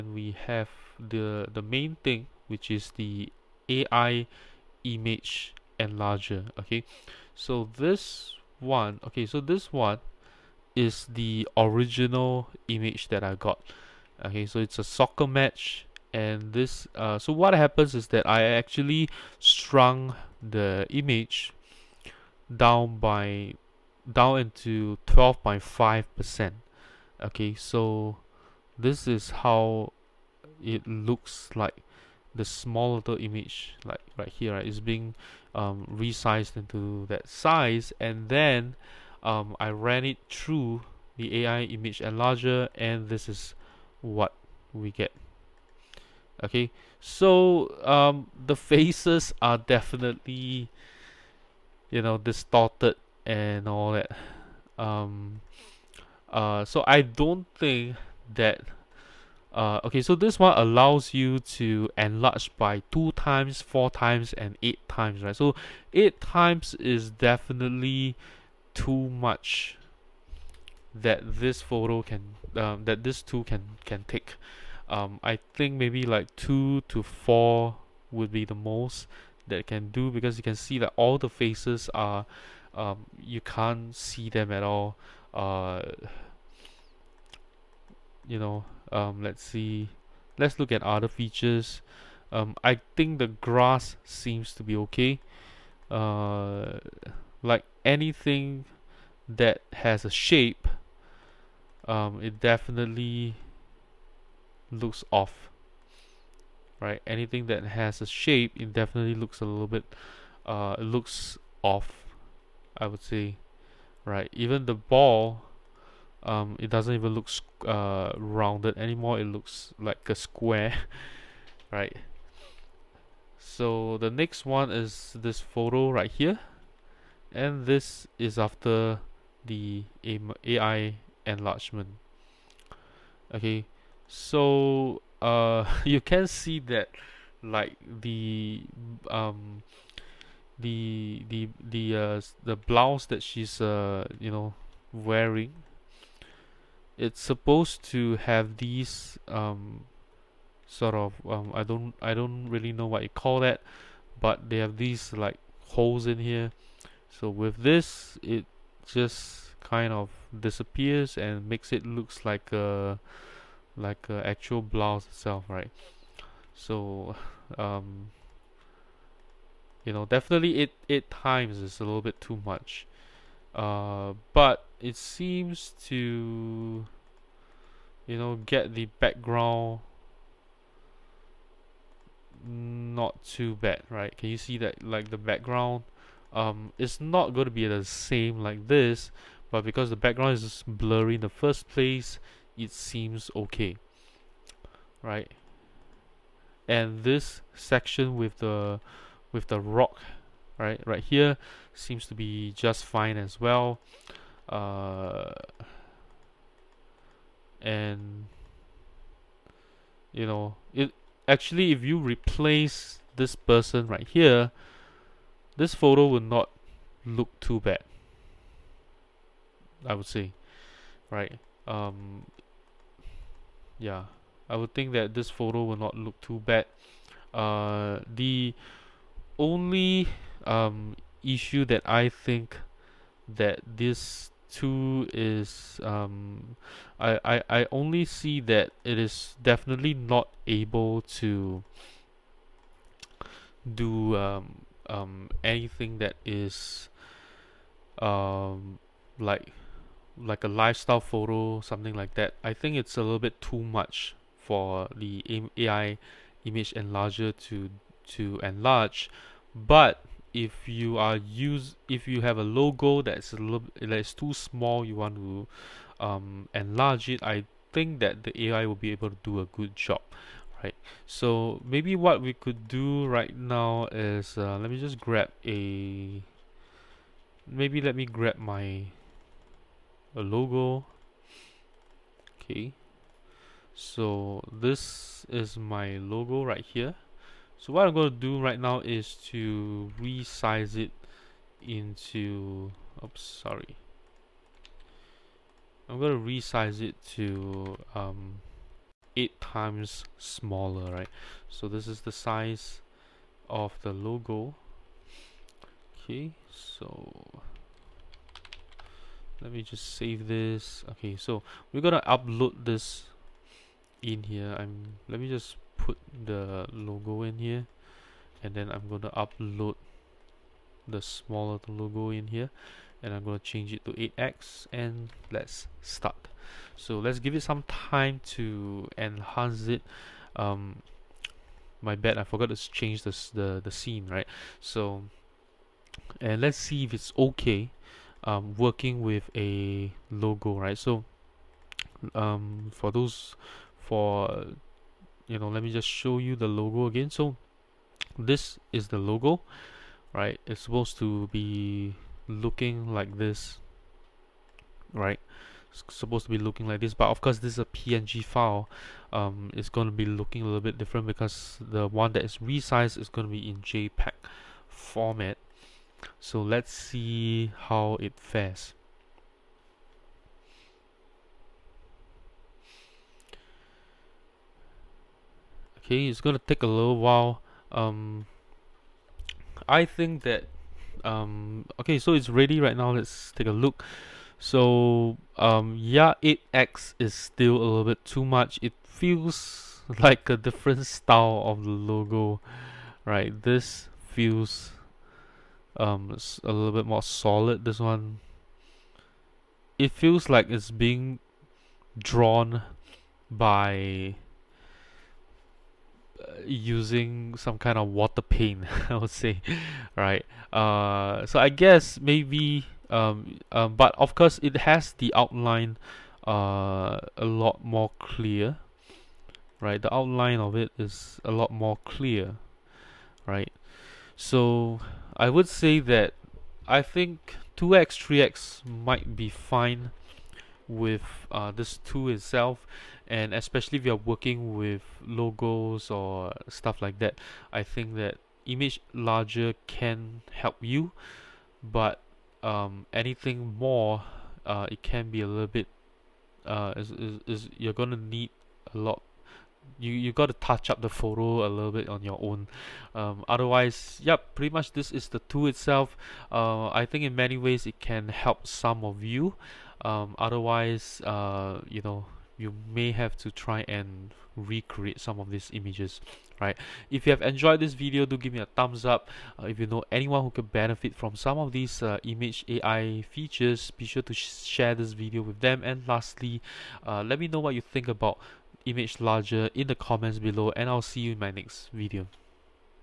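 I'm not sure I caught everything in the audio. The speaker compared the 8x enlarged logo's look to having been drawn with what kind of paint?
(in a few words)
Water paint.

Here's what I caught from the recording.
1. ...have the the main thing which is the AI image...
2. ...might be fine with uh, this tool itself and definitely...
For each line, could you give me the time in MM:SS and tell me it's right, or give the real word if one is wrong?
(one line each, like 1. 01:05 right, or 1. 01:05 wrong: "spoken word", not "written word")
1. 00:00 right
2. 07:08 wrong: "especially", not "definitely".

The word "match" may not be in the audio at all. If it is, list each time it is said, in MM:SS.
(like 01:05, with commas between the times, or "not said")
00:15.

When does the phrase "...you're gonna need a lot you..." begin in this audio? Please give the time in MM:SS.
07:27.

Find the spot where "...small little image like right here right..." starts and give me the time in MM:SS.
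00:32.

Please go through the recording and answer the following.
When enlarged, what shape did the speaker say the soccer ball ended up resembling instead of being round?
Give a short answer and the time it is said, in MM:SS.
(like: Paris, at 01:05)
A square, at 02:00.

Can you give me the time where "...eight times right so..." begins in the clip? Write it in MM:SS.
01:04.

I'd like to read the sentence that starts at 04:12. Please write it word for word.
I think it's a little bit too much for the AI image enlarger to to enlarge.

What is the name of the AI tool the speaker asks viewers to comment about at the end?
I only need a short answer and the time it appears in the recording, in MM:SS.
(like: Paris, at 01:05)
ImgLarger, at 07:58.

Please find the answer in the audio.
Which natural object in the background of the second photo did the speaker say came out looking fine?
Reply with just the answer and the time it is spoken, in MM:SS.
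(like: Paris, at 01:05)
Rock, at 03:19.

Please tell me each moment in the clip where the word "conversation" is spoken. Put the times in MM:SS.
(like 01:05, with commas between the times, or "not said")
not said.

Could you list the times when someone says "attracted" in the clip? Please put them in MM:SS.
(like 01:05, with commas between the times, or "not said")
not said.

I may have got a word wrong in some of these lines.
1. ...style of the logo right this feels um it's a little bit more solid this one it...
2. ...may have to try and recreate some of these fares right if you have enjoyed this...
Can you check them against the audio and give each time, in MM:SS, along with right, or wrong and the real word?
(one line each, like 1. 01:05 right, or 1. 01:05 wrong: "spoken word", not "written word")
1. 06:30 right
2. 07:42 wrong: "images", not "fares".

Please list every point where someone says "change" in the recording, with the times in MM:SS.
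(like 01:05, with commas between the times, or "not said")
05:23, 05:32.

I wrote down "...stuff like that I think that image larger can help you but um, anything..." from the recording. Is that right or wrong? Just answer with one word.
right.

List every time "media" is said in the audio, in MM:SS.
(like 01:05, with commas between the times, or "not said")
not said.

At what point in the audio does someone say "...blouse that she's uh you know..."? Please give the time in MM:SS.
02:22.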